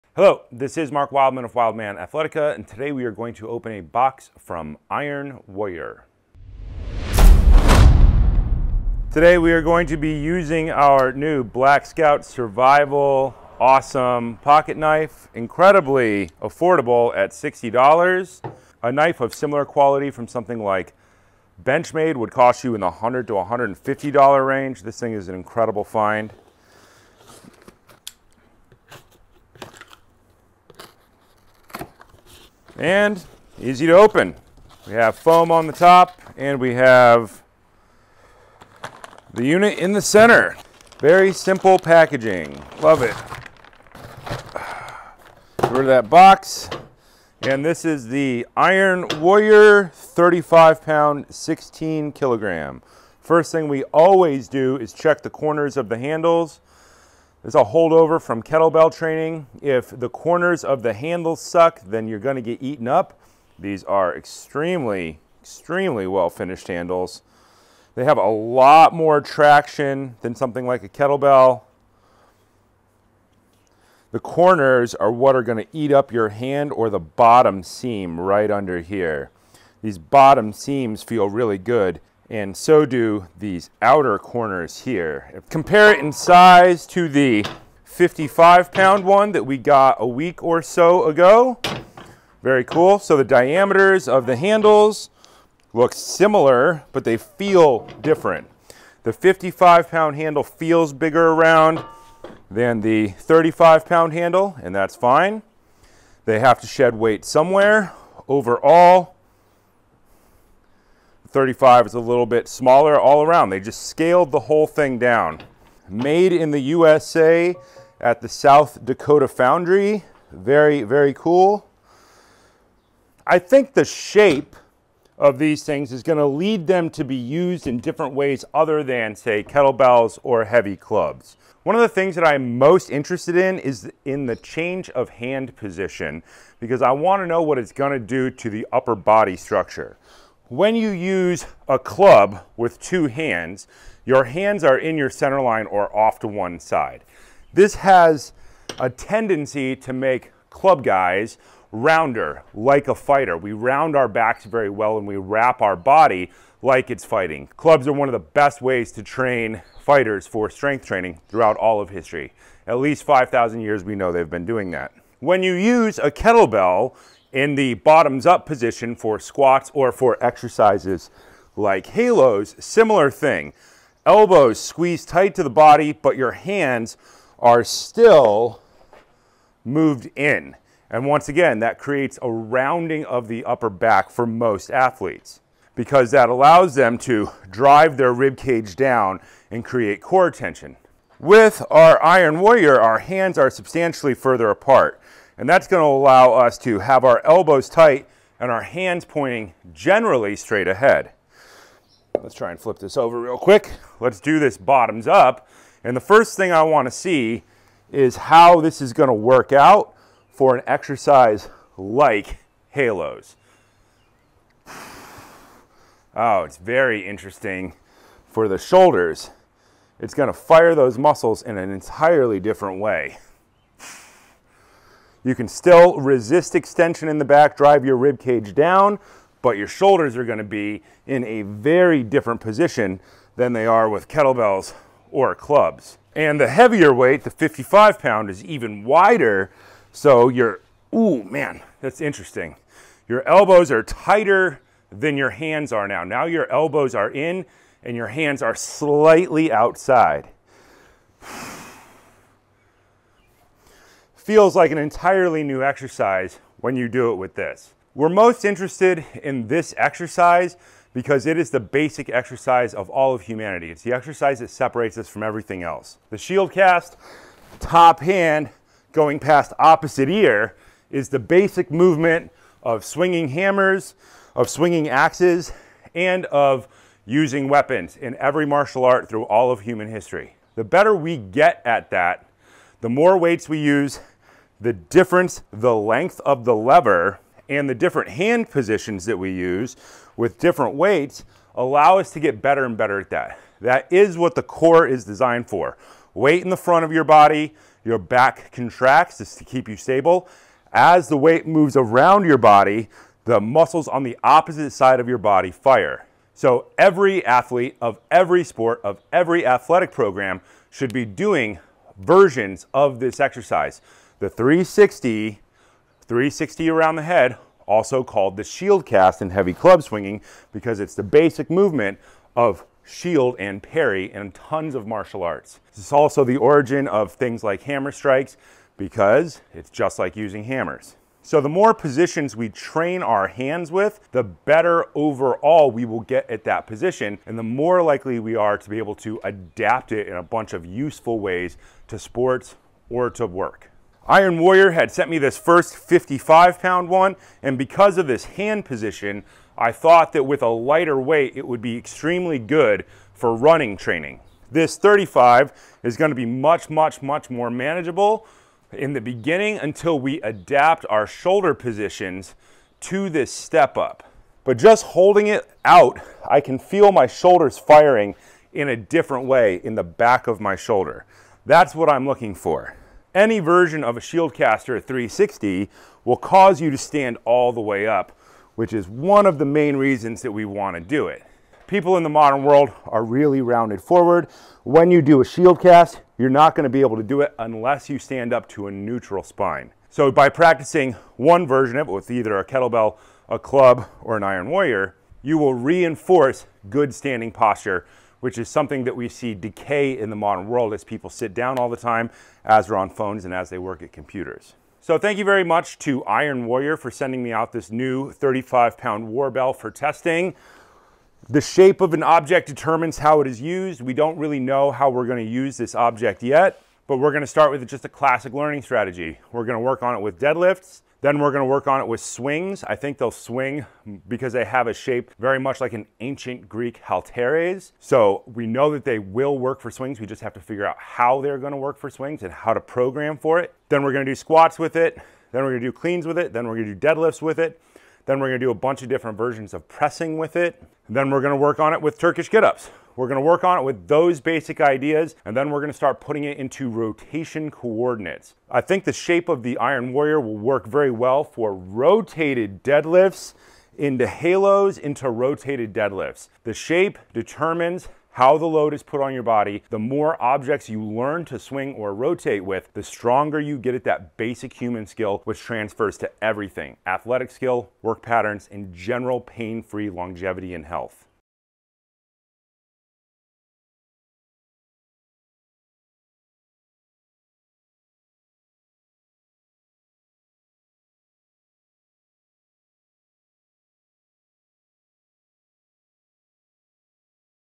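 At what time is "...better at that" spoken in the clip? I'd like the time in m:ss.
4:52.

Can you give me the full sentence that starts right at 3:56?
And the heavier weight, the 55 pound, is even wider.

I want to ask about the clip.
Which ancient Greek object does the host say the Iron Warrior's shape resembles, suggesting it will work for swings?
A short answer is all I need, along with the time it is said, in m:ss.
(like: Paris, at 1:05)
halteres, at 7:06.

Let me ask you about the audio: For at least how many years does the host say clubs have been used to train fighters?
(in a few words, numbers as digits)
5,000.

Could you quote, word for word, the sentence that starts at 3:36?
Oh, it's very interesting for the shoulders.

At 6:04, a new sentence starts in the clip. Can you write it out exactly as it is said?
But just holding it out, I can feel my shoulders firing in a different way in the back of my shoulder.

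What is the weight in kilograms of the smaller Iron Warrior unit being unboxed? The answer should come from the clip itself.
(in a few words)
16 kilograms.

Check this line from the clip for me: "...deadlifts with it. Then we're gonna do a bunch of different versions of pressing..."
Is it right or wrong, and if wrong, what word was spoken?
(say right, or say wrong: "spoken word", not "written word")
right.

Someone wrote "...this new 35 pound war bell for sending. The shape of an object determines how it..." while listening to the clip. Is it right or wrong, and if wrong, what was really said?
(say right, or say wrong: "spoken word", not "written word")
wrong: "testing", not "sending".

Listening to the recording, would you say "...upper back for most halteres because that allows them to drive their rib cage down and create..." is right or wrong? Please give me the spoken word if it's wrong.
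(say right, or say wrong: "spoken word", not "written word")
wrong: "athletes", not "halteres".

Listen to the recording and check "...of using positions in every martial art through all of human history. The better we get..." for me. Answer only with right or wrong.
wrong.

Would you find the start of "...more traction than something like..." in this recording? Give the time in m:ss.
1:08.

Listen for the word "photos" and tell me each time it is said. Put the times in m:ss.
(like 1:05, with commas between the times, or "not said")
not said.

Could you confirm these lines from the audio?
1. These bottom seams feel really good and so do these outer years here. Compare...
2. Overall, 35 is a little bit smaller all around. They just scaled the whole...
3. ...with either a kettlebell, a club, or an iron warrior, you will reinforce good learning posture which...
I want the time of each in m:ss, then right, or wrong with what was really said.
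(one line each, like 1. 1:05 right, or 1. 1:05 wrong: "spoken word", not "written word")
1. 1:19 wrong: "corners", not "years"
2. 1:48 right
3. 6:31 wrong: "standing", not "learning".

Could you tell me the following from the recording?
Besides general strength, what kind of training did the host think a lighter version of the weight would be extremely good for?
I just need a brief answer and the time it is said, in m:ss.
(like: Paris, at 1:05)
running training, at 5:53.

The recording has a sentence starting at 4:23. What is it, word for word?
It's the exercise that separates us from everything else.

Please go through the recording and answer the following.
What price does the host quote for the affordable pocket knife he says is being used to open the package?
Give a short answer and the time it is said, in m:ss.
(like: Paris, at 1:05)
$60, at 0:17.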